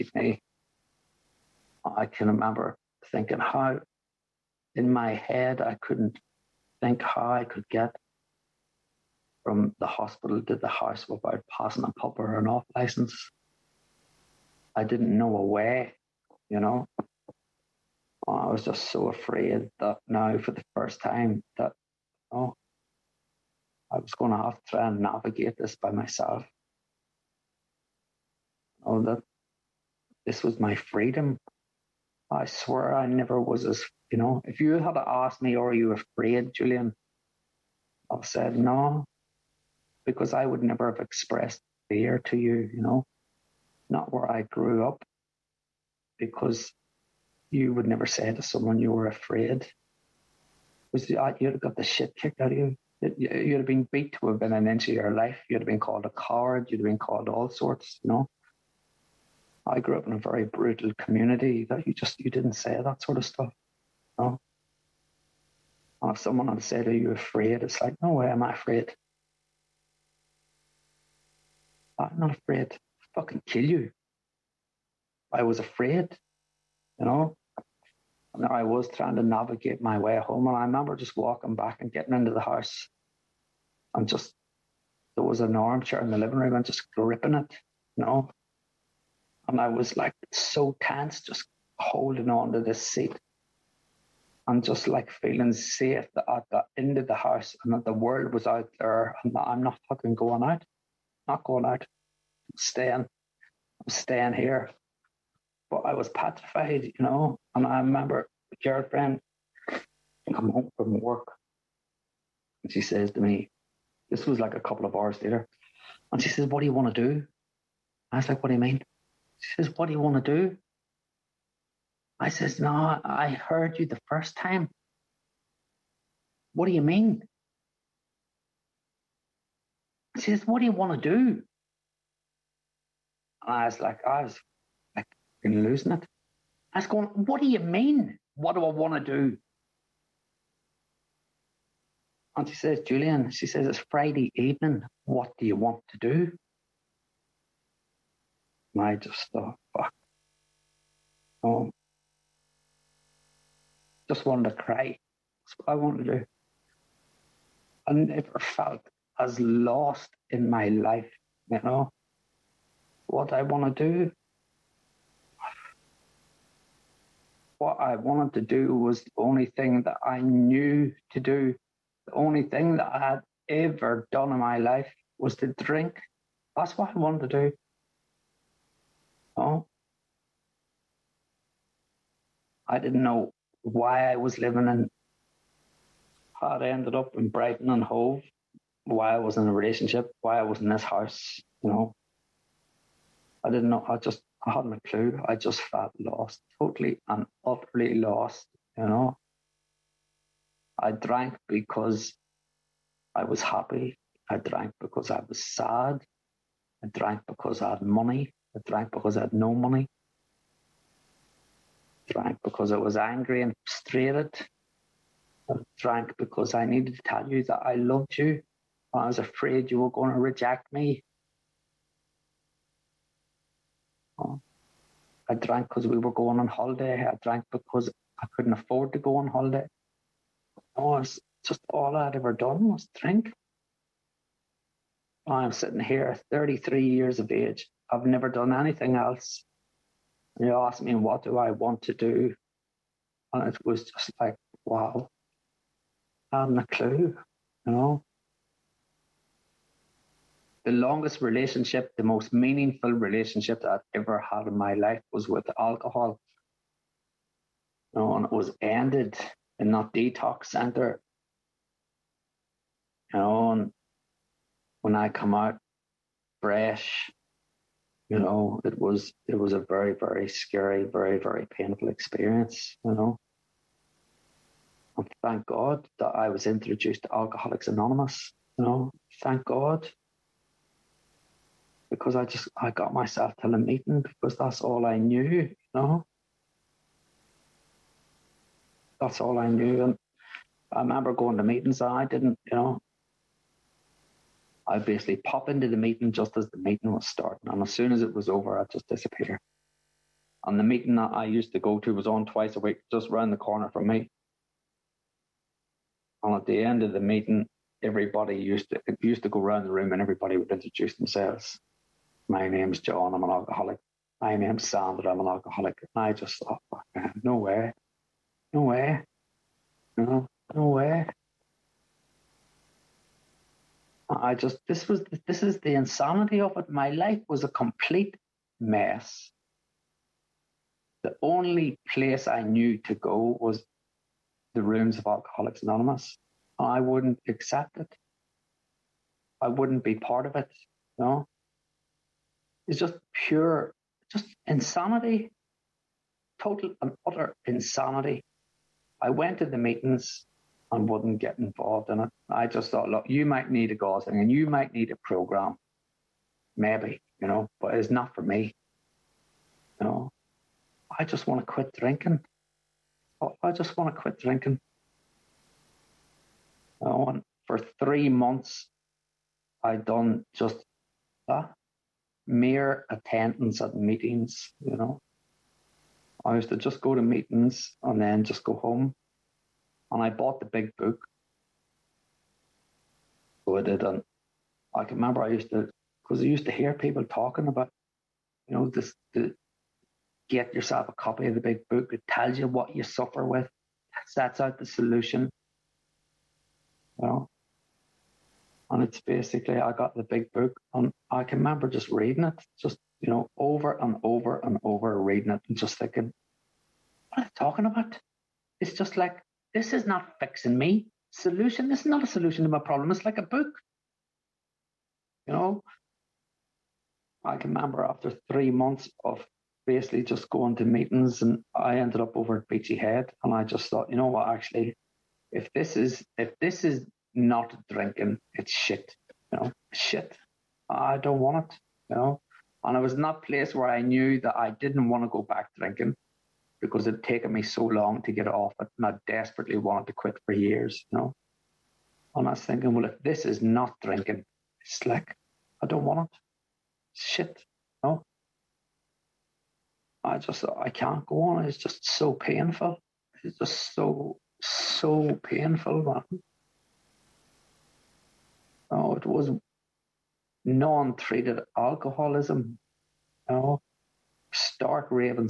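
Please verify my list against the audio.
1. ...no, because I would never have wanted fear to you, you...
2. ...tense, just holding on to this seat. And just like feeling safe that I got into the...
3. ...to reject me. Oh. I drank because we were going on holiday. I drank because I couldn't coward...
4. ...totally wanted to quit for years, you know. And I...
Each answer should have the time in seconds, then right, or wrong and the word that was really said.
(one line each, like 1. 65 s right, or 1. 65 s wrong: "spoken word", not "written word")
1. 38 s wrong: "expressed", not "wanted"
2. 90 s right
3. 220 s wrong: "afford", not "coward"
4. 439 s wrong: "desperately", not "totally".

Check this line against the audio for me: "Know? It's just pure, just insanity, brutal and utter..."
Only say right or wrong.
wrong.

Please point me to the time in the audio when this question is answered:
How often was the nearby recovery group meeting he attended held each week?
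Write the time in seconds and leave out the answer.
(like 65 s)
302 s.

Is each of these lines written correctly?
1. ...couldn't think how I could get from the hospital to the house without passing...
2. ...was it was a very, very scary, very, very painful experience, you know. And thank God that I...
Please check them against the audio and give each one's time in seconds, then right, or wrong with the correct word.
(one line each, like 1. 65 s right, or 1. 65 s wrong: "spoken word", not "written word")
1. 5 s right
2. 268 s right.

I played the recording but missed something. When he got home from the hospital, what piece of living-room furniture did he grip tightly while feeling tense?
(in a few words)
armchair.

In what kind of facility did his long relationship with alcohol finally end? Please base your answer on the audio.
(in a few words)
detox center.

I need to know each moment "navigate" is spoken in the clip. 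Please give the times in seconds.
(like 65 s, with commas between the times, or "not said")
24 s, 79 s.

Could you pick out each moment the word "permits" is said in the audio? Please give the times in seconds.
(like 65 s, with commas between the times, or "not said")
not said.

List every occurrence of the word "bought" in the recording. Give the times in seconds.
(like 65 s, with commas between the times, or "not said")
380 s.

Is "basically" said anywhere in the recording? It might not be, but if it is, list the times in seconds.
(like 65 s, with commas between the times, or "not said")
294 s, 399 s, 419 s.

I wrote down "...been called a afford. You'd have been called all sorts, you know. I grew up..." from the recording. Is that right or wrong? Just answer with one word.
wrong.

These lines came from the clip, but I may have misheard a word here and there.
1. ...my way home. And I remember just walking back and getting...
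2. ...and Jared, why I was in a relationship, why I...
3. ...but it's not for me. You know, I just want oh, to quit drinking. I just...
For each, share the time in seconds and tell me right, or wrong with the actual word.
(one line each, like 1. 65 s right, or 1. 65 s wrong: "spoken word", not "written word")
1. 79 s right
2. 187 s wrong: "Hove", not "Jared"
3. 357 s right.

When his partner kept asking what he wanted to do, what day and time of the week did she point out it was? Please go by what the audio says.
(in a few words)
Friday evening.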